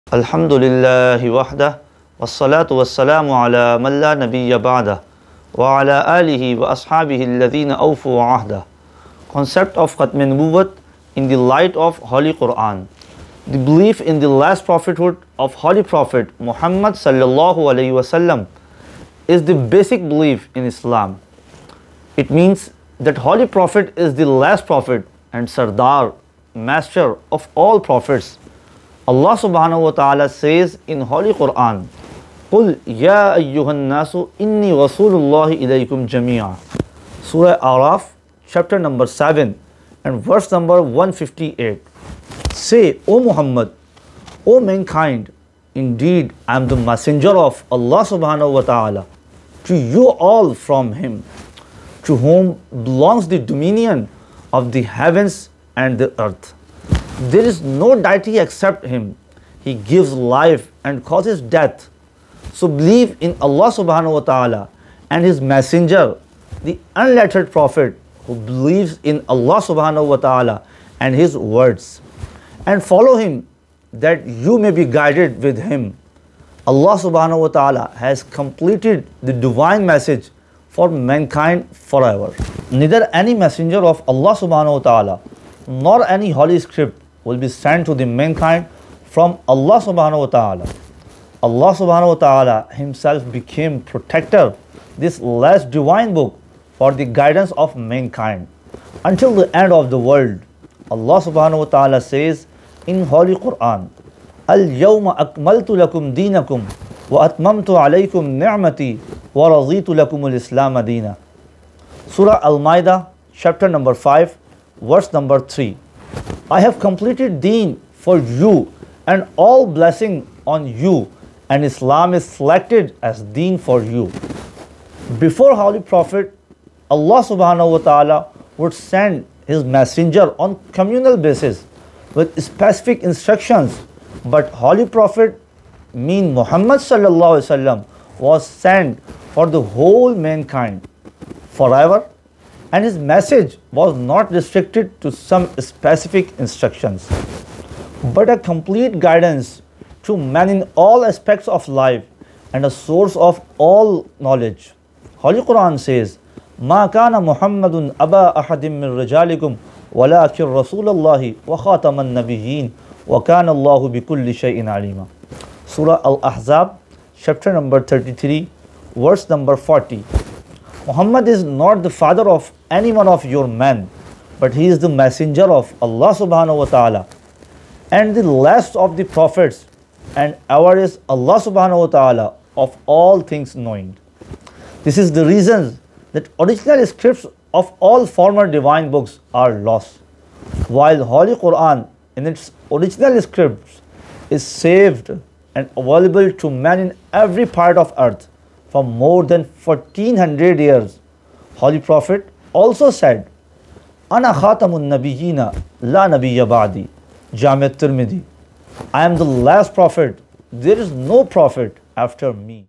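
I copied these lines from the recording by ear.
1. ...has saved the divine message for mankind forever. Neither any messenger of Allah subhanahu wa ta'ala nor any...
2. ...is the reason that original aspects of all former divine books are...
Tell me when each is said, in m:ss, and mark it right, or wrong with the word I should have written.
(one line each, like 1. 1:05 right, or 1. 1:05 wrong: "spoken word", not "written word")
1. 1:18 wrong: "completed", not "saved"
2. 3:04 wrong: "scripts", not "aspects".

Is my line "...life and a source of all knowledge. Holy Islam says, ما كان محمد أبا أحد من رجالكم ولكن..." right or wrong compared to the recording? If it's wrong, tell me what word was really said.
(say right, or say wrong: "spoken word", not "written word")
wrong: "Quran", not "Islam".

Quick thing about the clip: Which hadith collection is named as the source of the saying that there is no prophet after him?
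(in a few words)
Jami' at-Tirmidhi.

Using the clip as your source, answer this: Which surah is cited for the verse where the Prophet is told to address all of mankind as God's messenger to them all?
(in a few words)
Surah Araf.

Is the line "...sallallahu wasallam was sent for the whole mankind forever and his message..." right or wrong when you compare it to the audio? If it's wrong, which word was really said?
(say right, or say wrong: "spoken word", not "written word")
right.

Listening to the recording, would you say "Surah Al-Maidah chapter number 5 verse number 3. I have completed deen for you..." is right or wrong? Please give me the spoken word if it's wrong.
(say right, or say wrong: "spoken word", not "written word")
right.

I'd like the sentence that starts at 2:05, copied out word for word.
Before Holy Prophet, Allah subhanahu wa ta'ala would send his messenger on communal basis with specific instructions.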